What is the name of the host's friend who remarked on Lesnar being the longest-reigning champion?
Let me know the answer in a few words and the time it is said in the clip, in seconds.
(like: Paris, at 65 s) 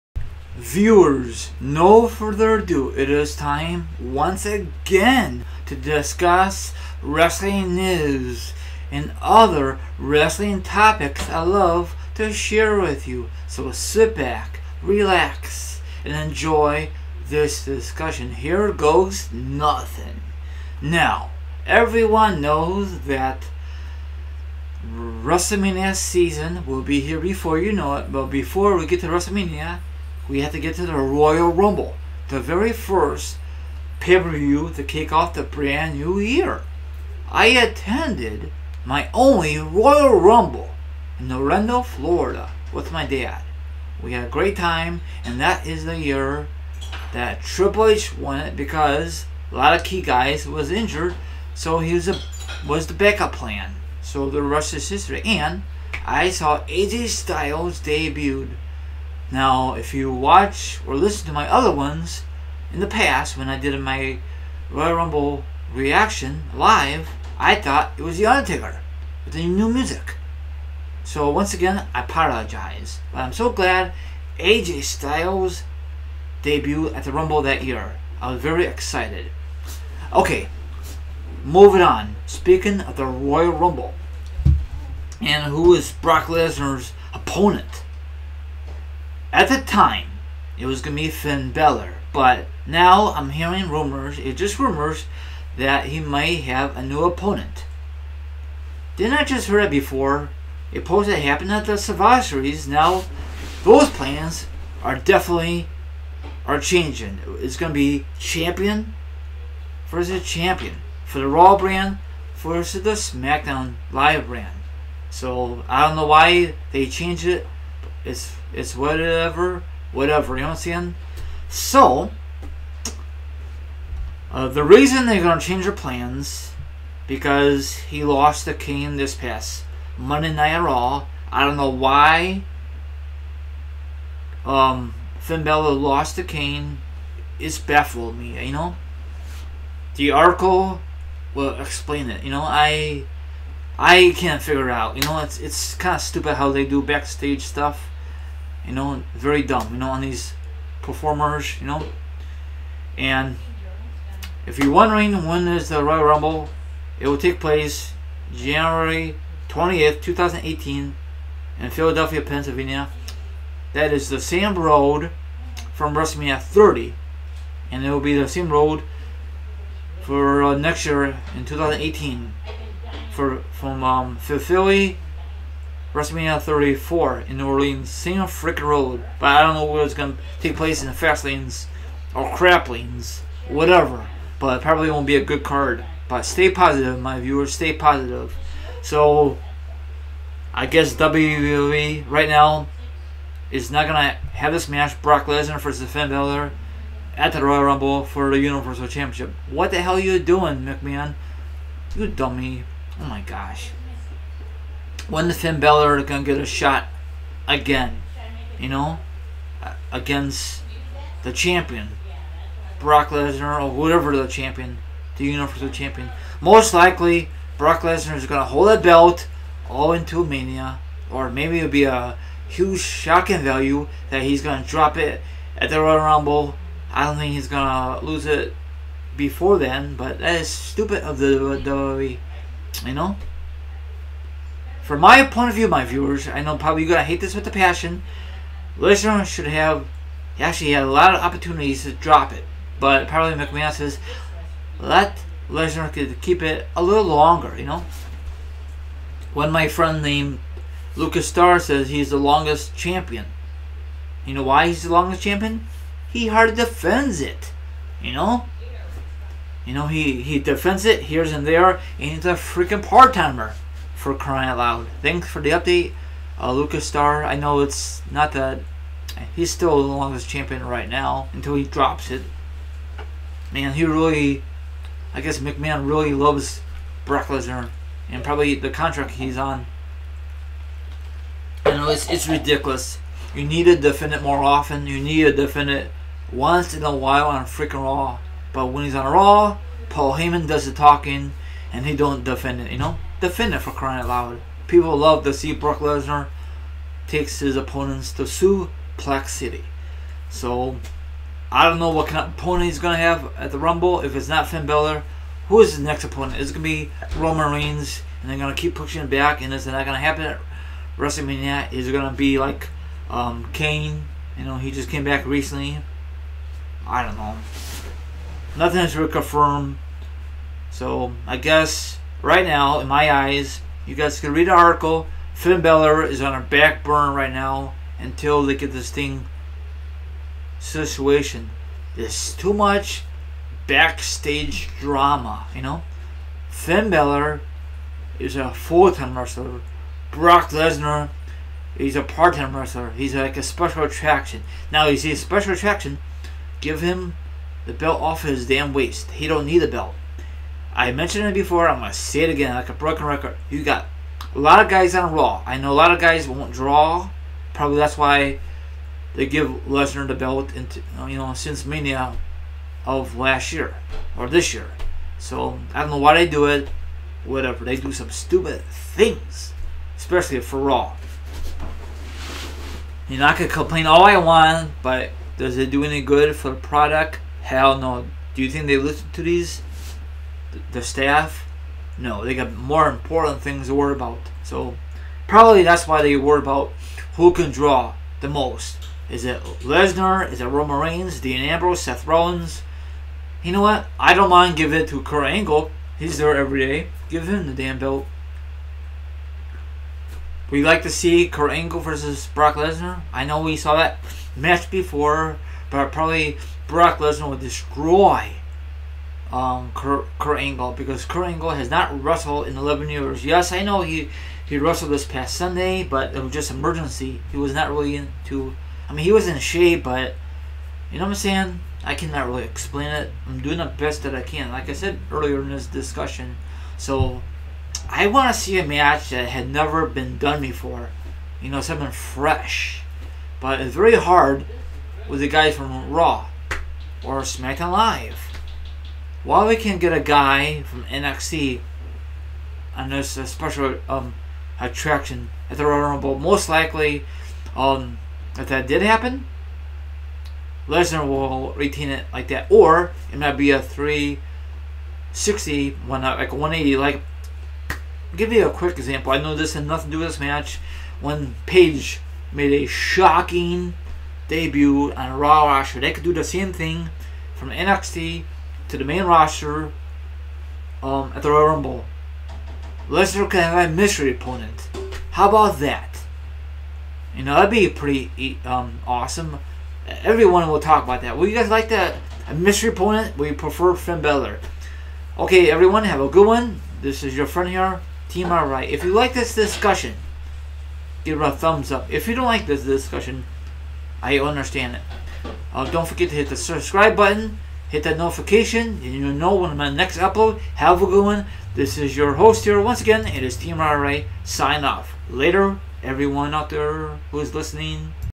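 Lucas Starr, at 250 s.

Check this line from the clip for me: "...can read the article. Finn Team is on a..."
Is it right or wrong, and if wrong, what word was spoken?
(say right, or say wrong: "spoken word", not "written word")
wrong: "Balor", not "Team".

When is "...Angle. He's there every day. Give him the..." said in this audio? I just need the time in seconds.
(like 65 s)
395 s.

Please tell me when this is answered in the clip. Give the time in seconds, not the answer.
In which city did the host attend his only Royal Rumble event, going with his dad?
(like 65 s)
41 s.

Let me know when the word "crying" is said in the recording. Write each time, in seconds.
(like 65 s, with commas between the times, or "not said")
264 s, 293 s.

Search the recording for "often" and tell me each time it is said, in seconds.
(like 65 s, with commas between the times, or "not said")
284 s.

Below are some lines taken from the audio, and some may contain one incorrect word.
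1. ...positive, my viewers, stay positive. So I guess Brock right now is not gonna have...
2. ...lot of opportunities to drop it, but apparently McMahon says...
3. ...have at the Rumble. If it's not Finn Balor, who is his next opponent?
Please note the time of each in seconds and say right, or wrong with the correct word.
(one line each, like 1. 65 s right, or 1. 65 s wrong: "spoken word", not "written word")
1. 186 s wrong: "WWE", not "Brock"
2. 240 s right
3. 302 s right.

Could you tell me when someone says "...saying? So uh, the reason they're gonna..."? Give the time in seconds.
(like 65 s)
120 s.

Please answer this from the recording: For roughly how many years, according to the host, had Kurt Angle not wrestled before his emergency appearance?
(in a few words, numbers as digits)
11.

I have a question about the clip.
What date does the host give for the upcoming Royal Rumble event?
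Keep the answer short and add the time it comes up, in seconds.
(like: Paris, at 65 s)
January 20th, 2018, at 158 s.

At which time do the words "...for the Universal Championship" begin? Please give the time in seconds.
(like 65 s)
198 s.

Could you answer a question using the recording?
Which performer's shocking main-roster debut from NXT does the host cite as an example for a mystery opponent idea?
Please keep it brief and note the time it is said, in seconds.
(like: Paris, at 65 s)
Paige, at 461 s.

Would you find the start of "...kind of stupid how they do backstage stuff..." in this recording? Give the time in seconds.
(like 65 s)
145 s.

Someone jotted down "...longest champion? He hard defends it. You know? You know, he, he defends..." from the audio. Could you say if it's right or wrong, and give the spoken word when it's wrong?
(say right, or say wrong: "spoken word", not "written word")
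right.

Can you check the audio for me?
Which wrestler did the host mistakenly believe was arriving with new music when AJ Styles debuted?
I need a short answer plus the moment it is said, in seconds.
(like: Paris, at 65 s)
The Undertaker, at 68 s.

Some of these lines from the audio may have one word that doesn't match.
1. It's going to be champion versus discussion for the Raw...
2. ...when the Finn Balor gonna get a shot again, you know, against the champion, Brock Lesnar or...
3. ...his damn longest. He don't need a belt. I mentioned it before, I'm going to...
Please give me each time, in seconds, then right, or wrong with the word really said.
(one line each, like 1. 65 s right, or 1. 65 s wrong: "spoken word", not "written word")
1. 107 s wrong: "champion", not "discussion"
2. 205 s right
3. 348 s wrong: "waist", not "longest".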